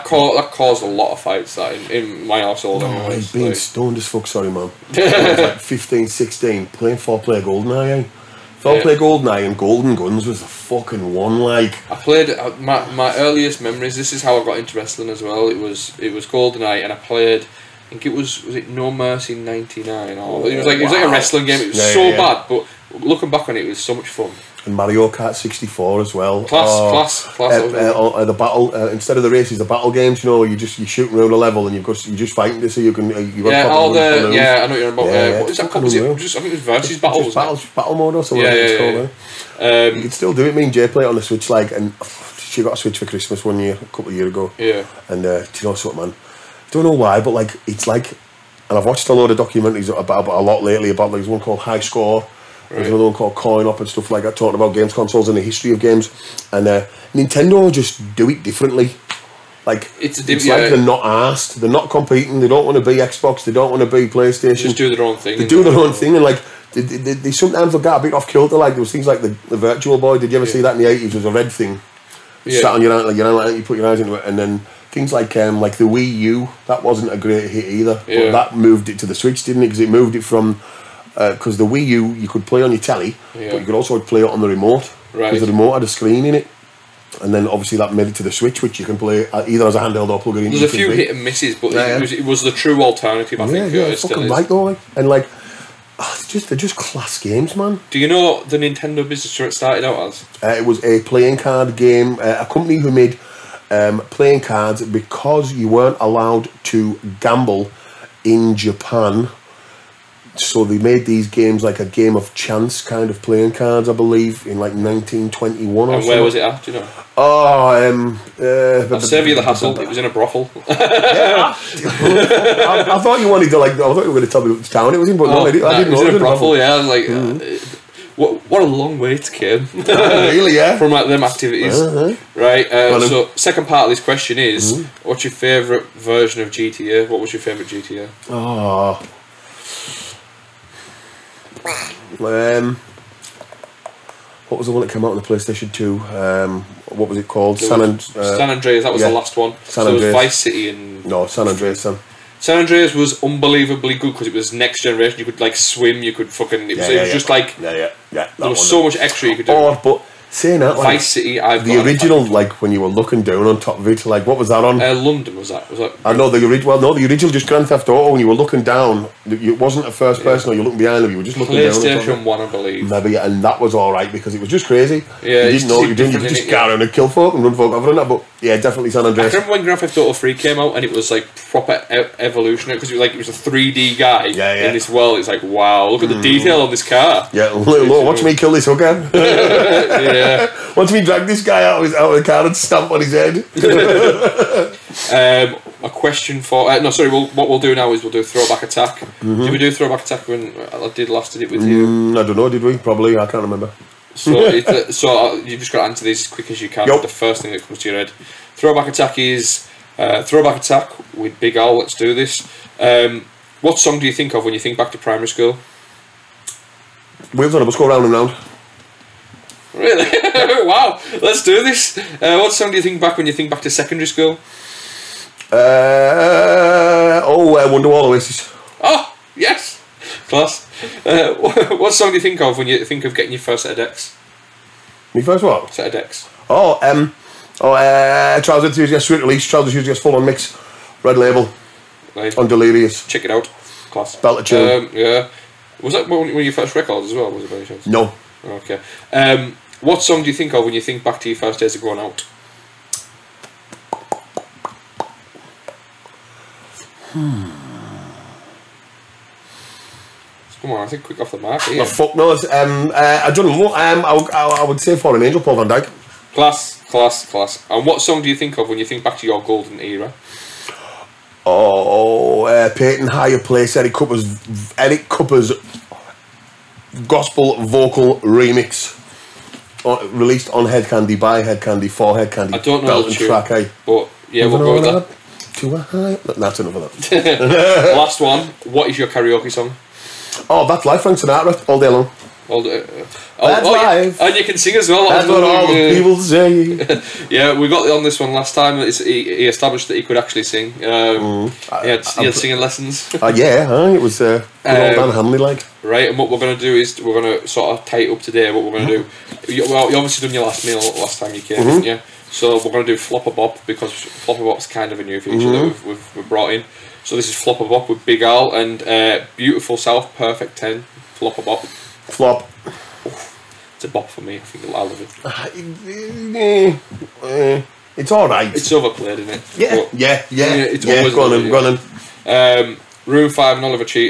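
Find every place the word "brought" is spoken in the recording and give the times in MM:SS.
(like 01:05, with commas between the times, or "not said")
05:16.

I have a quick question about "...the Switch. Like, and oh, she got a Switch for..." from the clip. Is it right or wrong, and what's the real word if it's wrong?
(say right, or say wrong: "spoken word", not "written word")
right.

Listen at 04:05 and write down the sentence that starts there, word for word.
Was that one of your first records as well, was it by chance?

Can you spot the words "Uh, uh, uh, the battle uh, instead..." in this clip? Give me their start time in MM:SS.
00:27.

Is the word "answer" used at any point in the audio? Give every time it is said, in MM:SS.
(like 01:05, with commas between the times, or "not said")
03:25.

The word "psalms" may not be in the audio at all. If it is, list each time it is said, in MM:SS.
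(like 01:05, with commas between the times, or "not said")
not said.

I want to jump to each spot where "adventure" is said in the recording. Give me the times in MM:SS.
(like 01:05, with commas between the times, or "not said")
not said.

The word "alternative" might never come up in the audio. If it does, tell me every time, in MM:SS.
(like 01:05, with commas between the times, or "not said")
01:32.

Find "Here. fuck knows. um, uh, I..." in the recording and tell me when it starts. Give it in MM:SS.
04:21.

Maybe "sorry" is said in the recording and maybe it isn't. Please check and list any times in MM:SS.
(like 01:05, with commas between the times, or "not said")
00:04, 03:16.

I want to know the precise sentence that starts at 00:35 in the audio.
Uh, yeah, what is that called?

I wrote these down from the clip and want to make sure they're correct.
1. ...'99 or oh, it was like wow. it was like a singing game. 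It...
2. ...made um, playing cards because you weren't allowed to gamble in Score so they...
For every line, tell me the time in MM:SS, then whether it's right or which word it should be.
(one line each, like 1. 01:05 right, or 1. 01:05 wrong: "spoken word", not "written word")
1. 00:19 wrong: "wrestling", not "singing"
2. 01:42 wrong: "Japan", not "Score".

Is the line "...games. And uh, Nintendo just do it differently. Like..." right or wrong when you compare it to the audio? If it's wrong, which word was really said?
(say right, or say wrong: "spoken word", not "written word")
right.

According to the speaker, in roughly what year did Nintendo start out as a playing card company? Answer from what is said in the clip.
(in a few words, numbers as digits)
1921.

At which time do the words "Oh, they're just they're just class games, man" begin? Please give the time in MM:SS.
01:35.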